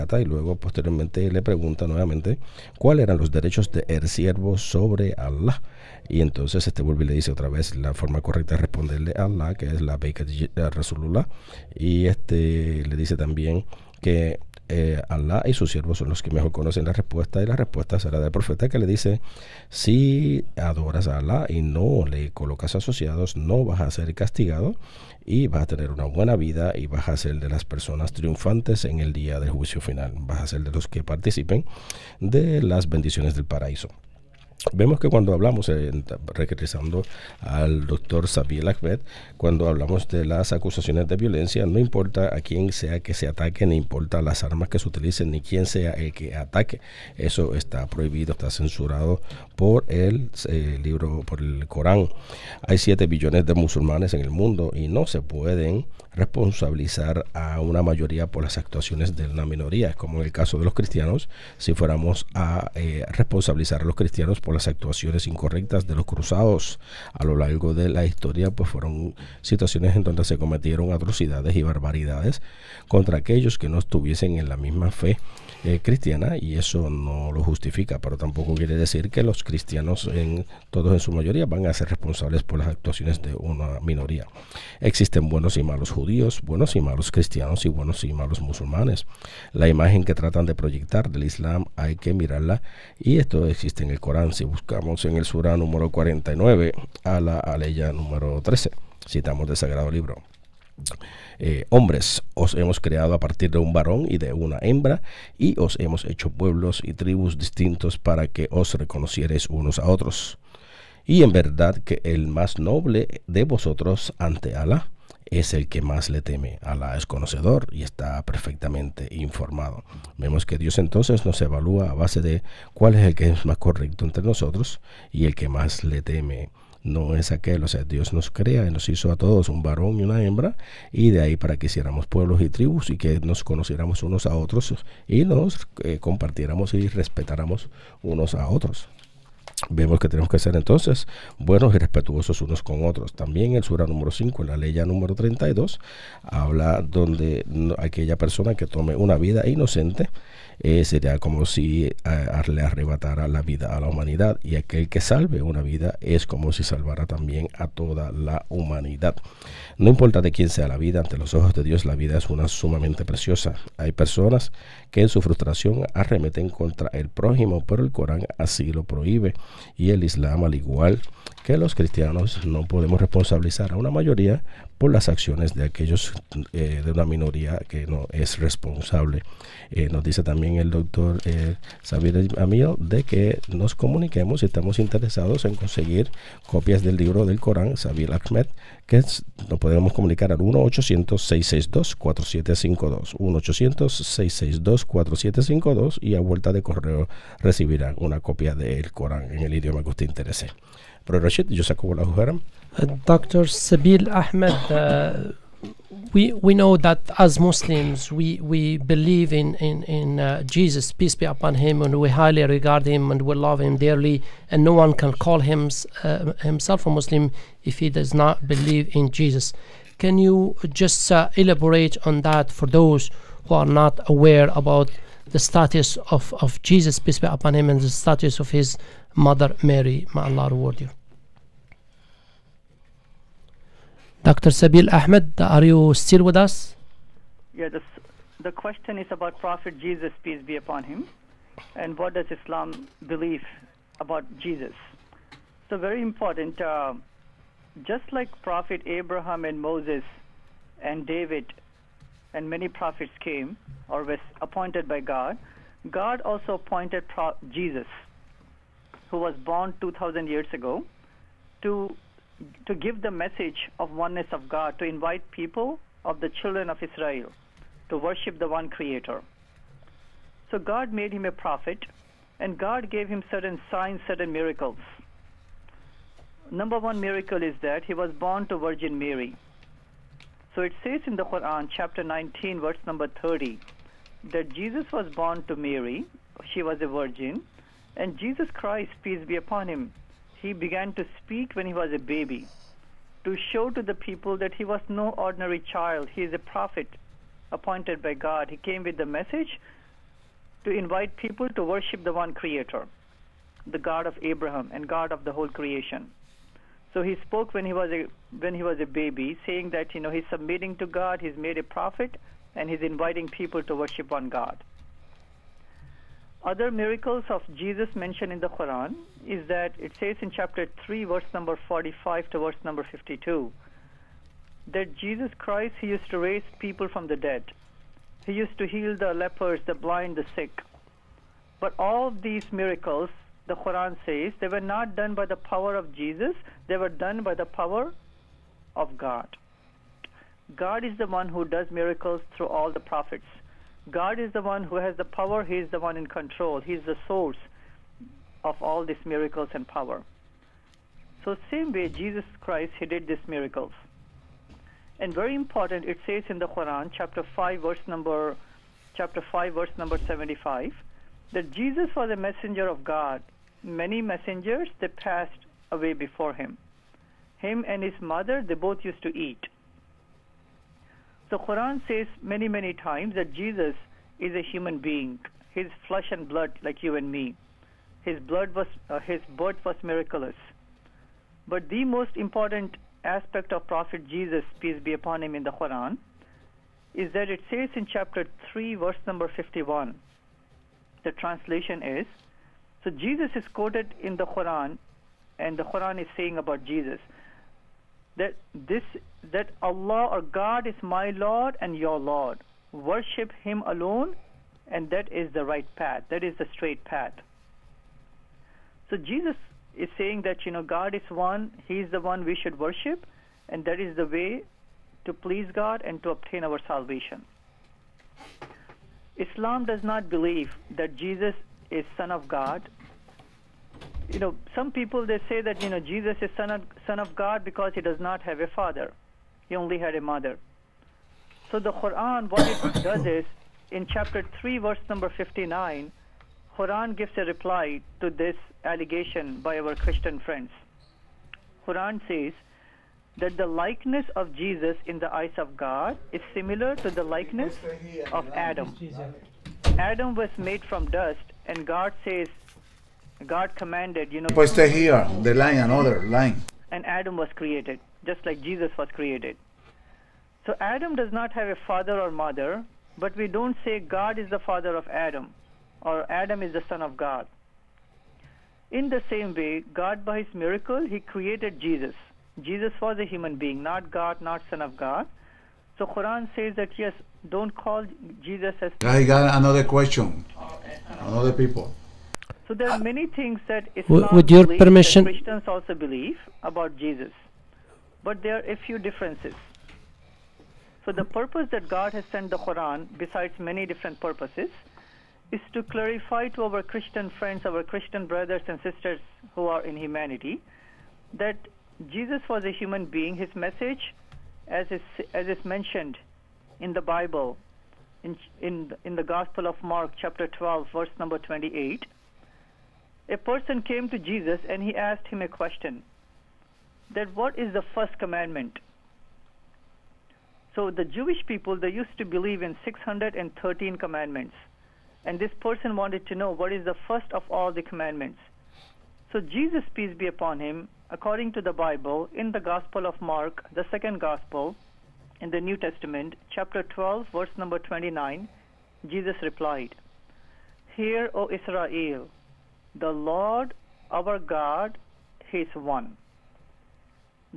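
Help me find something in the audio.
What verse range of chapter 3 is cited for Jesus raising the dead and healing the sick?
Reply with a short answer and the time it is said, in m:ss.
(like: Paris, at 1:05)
45 to 52, at 5:21.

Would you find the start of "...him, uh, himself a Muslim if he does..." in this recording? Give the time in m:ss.
3:35.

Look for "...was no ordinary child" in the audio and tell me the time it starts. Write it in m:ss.
4:54.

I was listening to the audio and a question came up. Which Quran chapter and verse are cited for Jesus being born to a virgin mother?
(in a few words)
Chapter 19, verse 30.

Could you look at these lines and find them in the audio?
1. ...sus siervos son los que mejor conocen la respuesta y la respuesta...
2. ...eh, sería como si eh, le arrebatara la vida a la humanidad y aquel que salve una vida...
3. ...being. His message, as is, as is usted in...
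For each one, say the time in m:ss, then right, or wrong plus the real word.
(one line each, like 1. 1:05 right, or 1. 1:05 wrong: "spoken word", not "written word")
1. 0:15 right
2. 2:30 right
3. 8:22 wrong: "mentioned", not "usted".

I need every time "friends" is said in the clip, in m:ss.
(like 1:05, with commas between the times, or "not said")
7:20, 8:17.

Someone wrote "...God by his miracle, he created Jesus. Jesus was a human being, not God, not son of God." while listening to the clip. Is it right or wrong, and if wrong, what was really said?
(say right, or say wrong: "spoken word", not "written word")
right.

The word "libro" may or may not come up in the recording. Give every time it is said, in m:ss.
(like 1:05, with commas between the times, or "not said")
0:50, 1:39, 3:06.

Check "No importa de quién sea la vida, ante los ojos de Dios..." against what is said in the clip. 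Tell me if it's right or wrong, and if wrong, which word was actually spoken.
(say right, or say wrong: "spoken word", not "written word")
right.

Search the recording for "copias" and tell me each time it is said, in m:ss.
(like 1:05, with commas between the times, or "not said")
3:06, 3:18.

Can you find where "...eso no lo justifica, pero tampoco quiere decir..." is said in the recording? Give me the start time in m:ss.
1:16.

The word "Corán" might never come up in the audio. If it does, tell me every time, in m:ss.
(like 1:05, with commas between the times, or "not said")
0:51, 1:33, 2:47, 3:07, 3:18.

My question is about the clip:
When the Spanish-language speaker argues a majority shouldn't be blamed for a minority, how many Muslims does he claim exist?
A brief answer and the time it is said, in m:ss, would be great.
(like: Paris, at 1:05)
7 billion, at 0:52.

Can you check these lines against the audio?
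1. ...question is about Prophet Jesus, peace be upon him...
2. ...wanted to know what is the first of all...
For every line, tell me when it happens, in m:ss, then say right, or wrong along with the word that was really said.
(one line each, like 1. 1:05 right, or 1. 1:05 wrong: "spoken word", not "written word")
1. 3:58 right
2. 8:45 right.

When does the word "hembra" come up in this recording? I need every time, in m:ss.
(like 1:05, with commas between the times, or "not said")
1:44, 2:10.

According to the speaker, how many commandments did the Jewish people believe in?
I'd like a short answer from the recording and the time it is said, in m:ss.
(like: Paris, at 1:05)
613, at 8:42.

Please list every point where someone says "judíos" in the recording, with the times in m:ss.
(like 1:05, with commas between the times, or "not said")
1:25.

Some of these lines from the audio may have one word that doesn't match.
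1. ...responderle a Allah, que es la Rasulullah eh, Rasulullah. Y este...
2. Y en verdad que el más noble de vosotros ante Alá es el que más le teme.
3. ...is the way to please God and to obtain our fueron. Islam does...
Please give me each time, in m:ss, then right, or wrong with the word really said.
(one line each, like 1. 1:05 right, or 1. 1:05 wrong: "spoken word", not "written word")
1. 0:08 wrong: "Beika", not "Rasulullah"
2. 1:51 right
3. 6:53 wrong: "salvation", not "fueron".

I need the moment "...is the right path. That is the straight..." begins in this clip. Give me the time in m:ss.
6:45.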